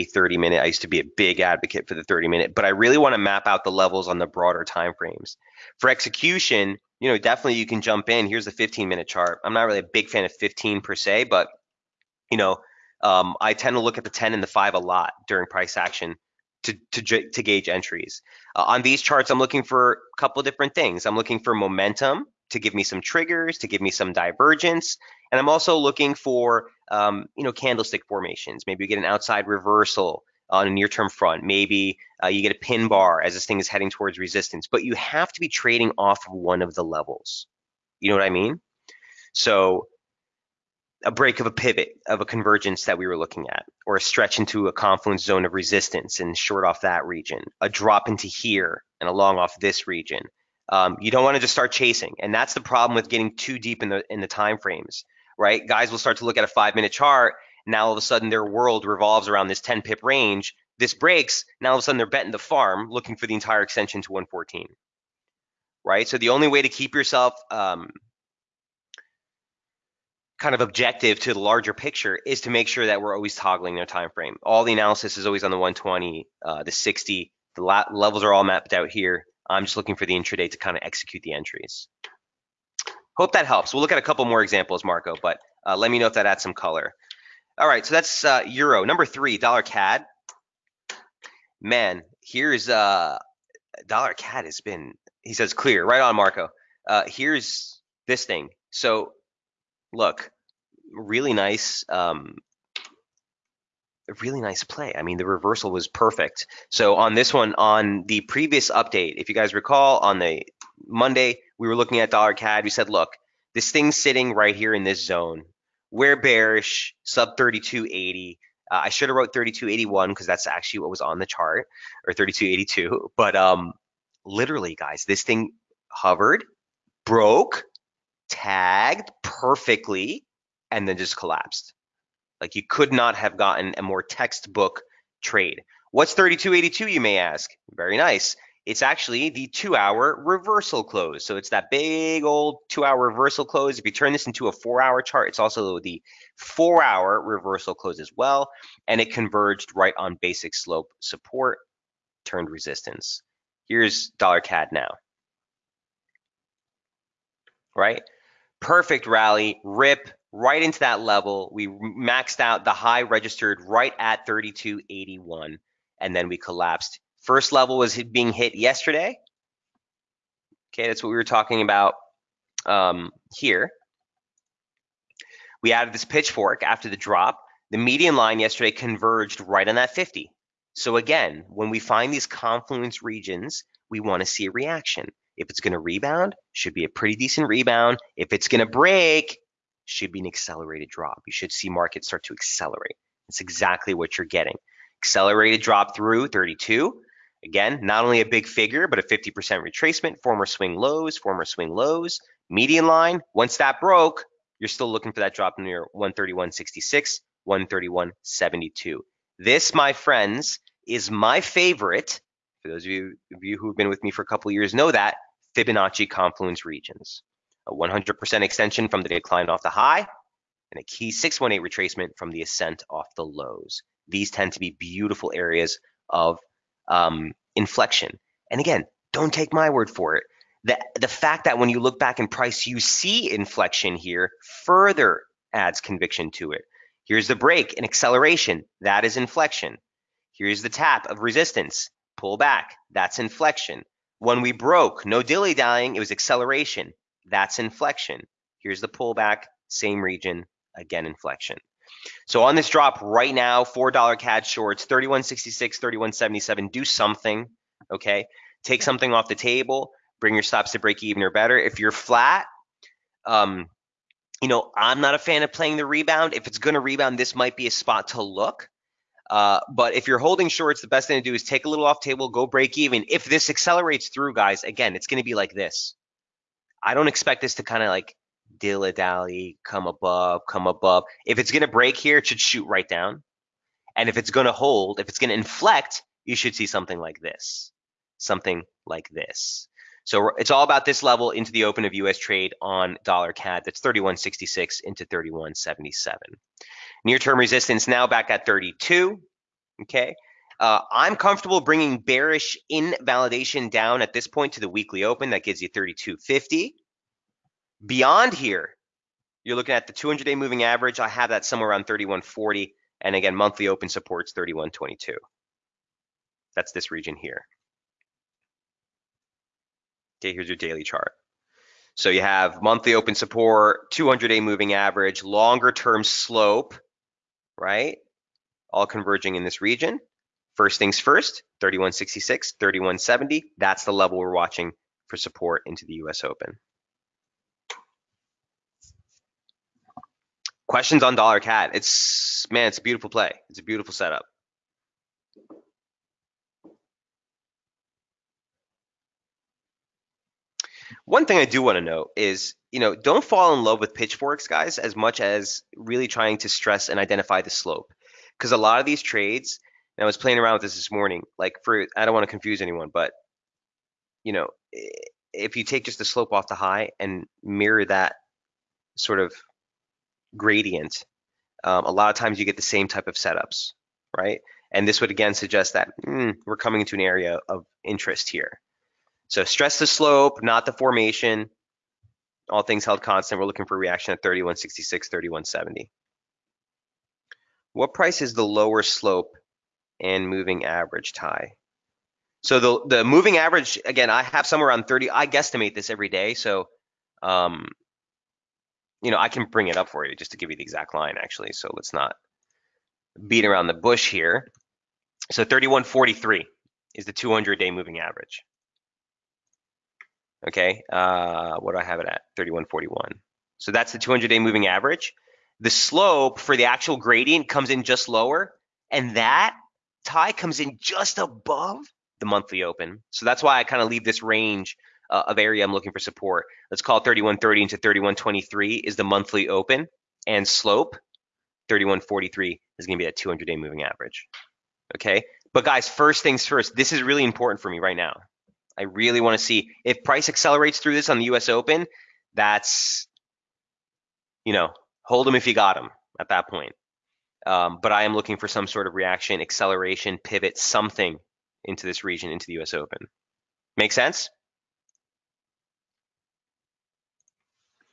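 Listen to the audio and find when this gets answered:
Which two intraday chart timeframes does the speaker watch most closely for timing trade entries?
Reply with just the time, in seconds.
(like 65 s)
14 s.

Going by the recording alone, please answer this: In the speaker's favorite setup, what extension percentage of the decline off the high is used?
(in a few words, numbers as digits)
100%.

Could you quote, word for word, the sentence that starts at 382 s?
All things held constant, we're looking for reaction at 3166, 3170.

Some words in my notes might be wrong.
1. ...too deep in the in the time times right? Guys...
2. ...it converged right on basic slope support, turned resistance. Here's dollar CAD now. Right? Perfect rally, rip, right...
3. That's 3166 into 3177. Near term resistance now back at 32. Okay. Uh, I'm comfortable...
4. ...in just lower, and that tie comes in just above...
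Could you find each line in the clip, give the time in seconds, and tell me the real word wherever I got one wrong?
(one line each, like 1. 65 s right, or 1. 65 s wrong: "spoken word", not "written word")
1. 53 s wrong: "frames", not "times"
2. 149 s right
3. 293 s right
4. 417 s right.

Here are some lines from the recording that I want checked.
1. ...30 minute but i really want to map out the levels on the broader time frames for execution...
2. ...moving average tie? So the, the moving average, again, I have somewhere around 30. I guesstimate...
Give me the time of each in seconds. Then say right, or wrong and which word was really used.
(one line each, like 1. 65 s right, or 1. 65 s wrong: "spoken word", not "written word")
1. 2 s right
2. 390 s right.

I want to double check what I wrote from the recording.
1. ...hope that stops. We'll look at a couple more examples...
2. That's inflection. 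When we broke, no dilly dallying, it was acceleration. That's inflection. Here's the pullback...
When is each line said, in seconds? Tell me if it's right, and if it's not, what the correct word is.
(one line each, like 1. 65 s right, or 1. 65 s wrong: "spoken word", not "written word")
1. 83 s wrong: "helps", not "stops"
2. 242 s right.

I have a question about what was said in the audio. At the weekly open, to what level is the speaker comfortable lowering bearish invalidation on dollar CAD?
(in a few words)
3250.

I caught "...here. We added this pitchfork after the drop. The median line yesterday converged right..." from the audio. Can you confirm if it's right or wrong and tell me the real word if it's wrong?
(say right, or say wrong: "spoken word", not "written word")
right.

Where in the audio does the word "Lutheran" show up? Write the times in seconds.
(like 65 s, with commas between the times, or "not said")
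not said.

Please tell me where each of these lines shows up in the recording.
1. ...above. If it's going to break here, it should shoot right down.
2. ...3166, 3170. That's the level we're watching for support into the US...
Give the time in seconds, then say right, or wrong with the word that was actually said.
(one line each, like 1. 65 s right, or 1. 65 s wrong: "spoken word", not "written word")
1. 280 s right
2. 331 s right.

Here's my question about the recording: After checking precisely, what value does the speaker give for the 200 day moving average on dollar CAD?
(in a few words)
3141.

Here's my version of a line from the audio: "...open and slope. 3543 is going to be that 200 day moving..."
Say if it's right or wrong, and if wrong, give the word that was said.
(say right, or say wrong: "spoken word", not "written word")
wrong: "3143", not "3543".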